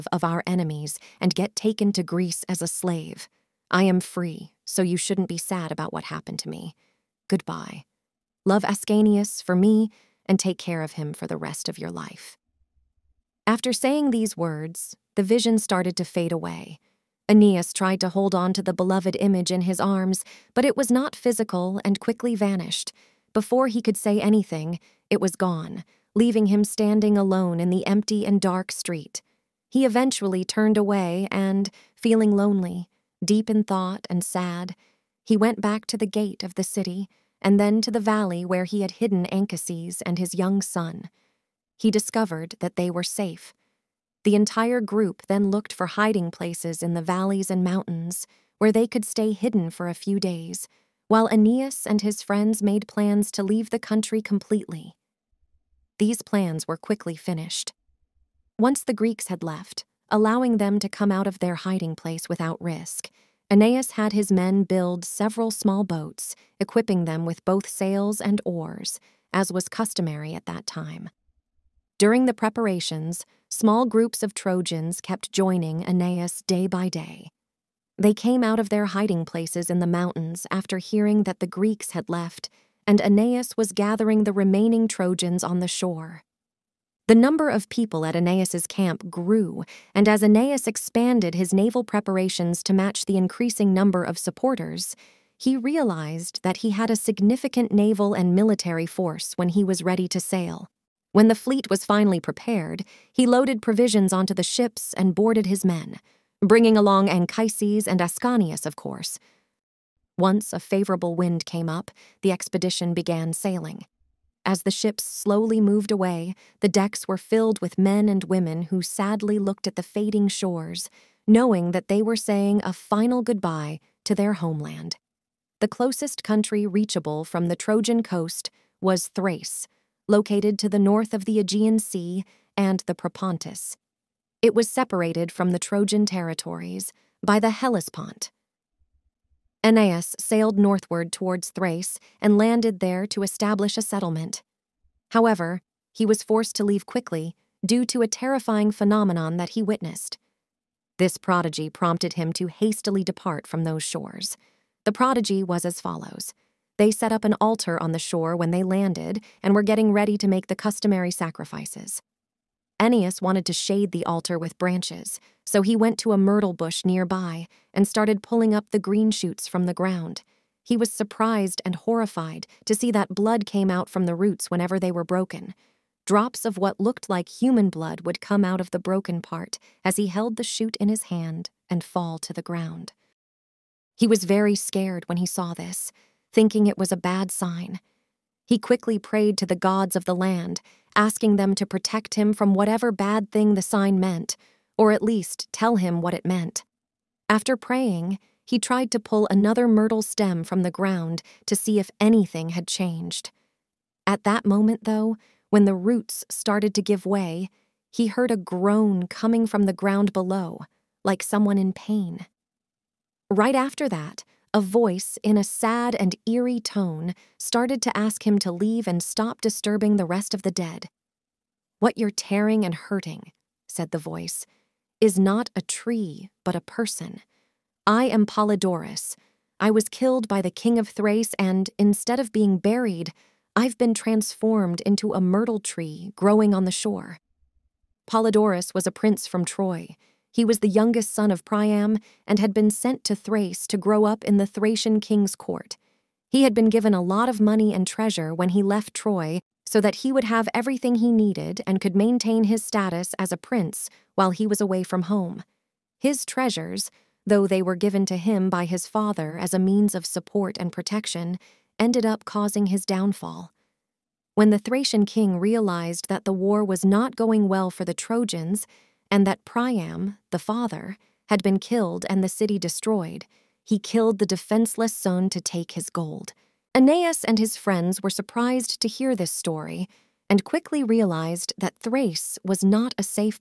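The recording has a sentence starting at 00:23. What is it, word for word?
Before he could say anything, it was gone, leaving him standing alone in the empty and dark street.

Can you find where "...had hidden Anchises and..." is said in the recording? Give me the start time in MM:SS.
00:38.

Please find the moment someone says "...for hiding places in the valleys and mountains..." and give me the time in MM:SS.
00:45.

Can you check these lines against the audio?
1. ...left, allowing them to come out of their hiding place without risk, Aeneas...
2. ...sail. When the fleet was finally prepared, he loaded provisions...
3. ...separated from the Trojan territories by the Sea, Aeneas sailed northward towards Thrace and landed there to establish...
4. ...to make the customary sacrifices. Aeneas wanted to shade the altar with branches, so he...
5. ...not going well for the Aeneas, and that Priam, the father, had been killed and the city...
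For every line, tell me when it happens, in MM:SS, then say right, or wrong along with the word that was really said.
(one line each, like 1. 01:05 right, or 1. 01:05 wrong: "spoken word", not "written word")
1. 00:59 right
2. 01:40 right
3. 02:14 wrong: "Hellespont", not "Sea"
4. 02:40 right
5. 04:26 wrong: "Trojans", not "Aeneas".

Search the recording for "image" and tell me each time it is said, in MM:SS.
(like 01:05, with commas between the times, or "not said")
00:19.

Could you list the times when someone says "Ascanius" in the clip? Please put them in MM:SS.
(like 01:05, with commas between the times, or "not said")
00:08, 01:48.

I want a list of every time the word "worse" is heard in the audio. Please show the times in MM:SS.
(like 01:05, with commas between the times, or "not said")
not said.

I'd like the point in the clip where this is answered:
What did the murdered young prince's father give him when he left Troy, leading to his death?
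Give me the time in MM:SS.
04:07.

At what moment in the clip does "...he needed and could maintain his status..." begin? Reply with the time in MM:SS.
04:10.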